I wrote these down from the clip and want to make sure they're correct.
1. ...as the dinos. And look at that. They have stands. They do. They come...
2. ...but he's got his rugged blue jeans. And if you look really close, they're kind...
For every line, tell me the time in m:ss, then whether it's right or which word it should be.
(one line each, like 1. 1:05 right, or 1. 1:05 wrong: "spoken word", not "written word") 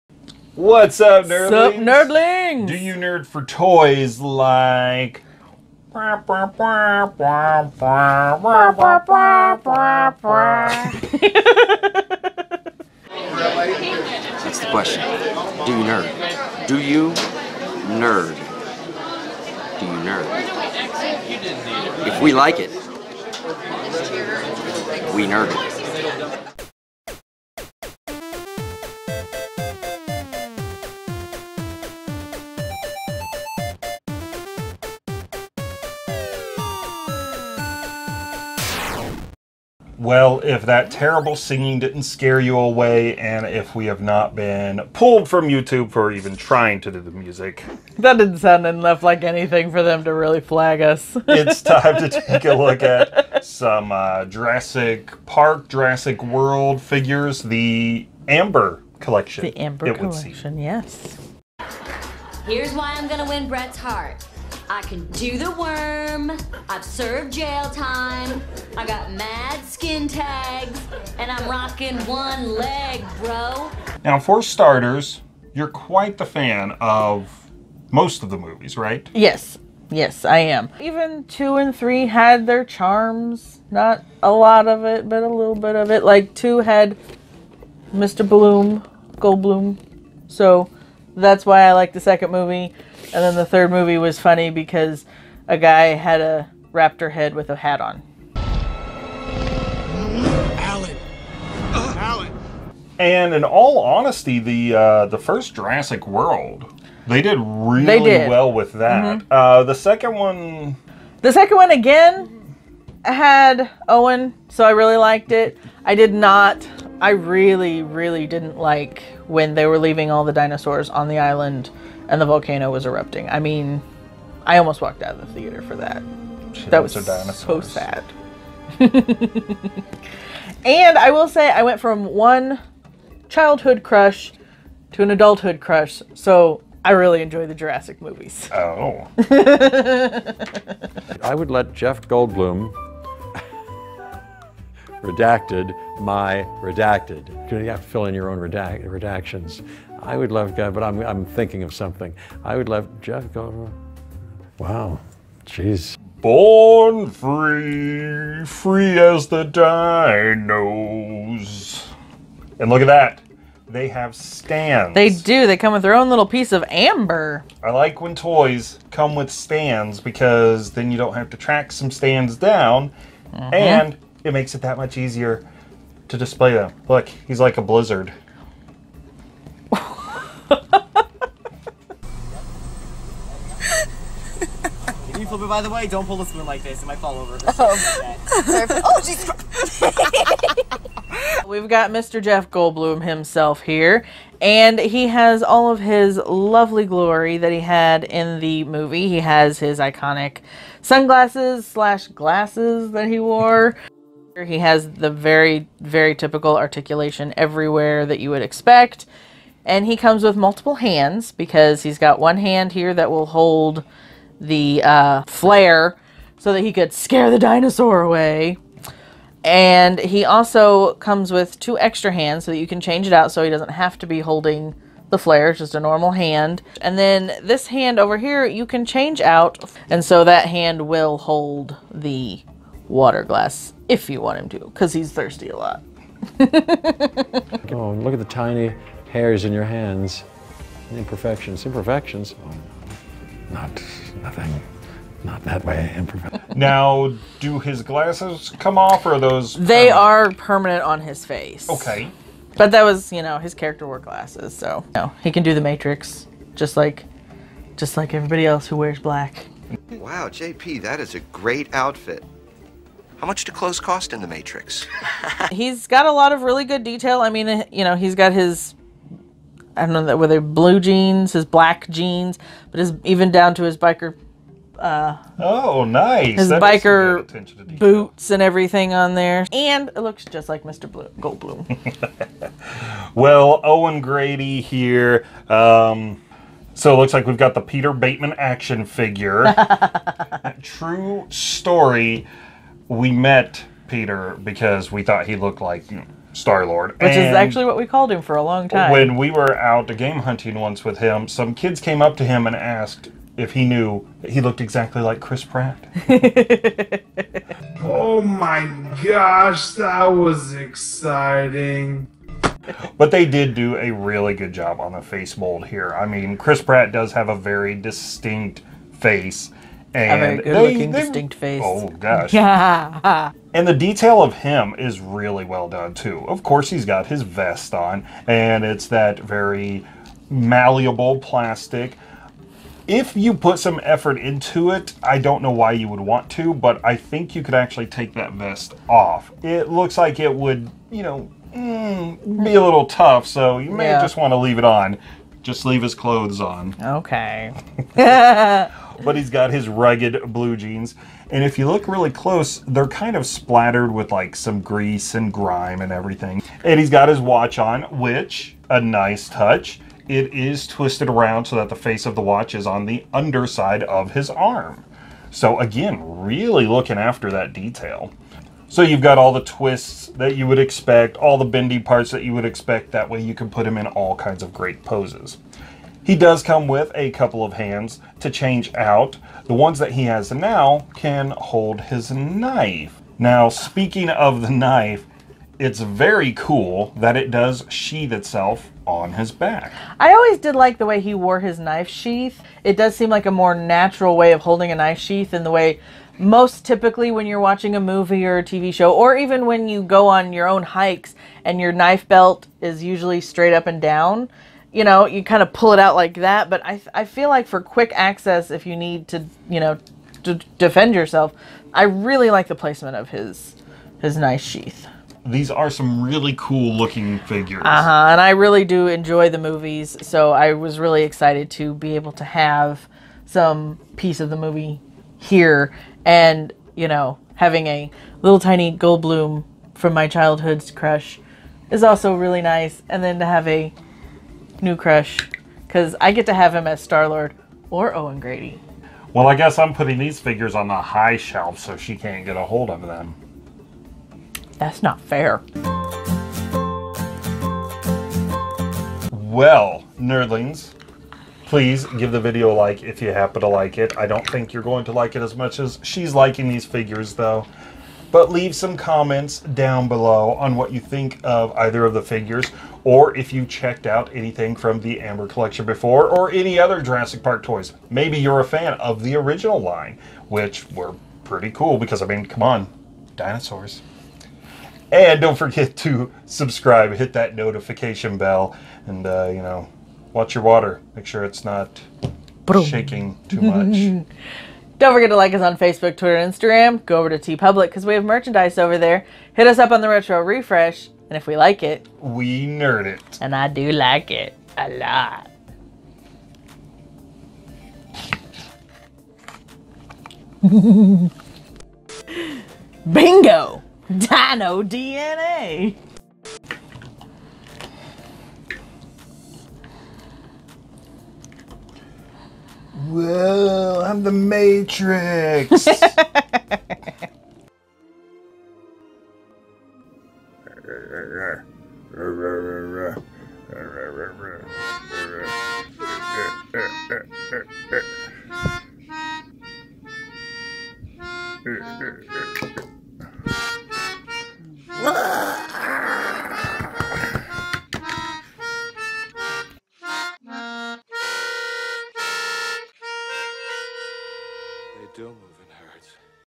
1. 2:38 right
2. 5:47 right.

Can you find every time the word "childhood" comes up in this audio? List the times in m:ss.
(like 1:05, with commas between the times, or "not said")
2:13, 7:10.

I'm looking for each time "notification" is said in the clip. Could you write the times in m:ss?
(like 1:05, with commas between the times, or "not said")
7:57.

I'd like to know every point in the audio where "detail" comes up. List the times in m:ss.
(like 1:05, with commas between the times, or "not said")
4:26, 5:23, 6:07.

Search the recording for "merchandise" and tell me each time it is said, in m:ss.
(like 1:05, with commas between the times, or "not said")
8:08.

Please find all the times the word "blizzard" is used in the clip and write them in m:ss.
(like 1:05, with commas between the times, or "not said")
2:57.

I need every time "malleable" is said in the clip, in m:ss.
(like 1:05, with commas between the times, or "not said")
5:30.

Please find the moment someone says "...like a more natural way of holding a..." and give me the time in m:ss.
6:33.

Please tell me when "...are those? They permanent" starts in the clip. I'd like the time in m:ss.
4:09.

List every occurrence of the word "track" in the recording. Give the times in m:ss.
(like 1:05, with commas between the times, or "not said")
2:51.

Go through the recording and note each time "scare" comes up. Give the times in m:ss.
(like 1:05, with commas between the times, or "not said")
0:42, 3:36.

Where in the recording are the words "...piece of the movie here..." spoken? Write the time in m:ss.
7:03.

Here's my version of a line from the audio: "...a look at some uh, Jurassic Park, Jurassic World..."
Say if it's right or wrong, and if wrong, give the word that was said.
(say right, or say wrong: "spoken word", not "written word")
right.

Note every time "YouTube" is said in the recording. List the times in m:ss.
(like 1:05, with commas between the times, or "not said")
0:45.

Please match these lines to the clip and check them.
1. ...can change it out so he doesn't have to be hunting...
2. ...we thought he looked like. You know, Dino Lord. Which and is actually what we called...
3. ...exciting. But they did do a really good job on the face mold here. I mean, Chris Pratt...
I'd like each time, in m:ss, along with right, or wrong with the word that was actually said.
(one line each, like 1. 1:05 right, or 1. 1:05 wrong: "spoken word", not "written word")
1. 3:42 wrong: "holding", not "hunting"
2. 4:54 wrong: "Star", not "Dino"
3. 5:10 right.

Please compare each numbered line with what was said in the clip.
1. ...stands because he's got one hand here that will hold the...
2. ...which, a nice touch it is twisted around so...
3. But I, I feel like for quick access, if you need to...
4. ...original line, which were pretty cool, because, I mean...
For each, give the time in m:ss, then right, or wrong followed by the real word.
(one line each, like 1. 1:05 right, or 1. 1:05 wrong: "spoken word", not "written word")
1. 3:30 wrong: "hands", not "stands"
2. 5:57 right
3. 6:46 right
4. 7:49 right.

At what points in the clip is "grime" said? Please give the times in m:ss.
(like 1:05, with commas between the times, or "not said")
5:55.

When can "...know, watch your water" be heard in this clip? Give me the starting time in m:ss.
7:59.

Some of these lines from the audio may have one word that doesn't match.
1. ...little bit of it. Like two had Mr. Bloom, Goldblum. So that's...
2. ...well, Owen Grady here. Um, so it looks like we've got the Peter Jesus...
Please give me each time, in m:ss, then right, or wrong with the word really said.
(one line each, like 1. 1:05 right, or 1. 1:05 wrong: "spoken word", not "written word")
1. 1:25 right
2. 4:43 wrong: "Batemon", not "Jesus".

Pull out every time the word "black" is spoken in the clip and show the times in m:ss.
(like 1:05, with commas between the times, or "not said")
4:18, 4:31.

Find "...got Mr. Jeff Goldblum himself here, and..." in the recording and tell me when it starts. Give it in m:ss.
3:11.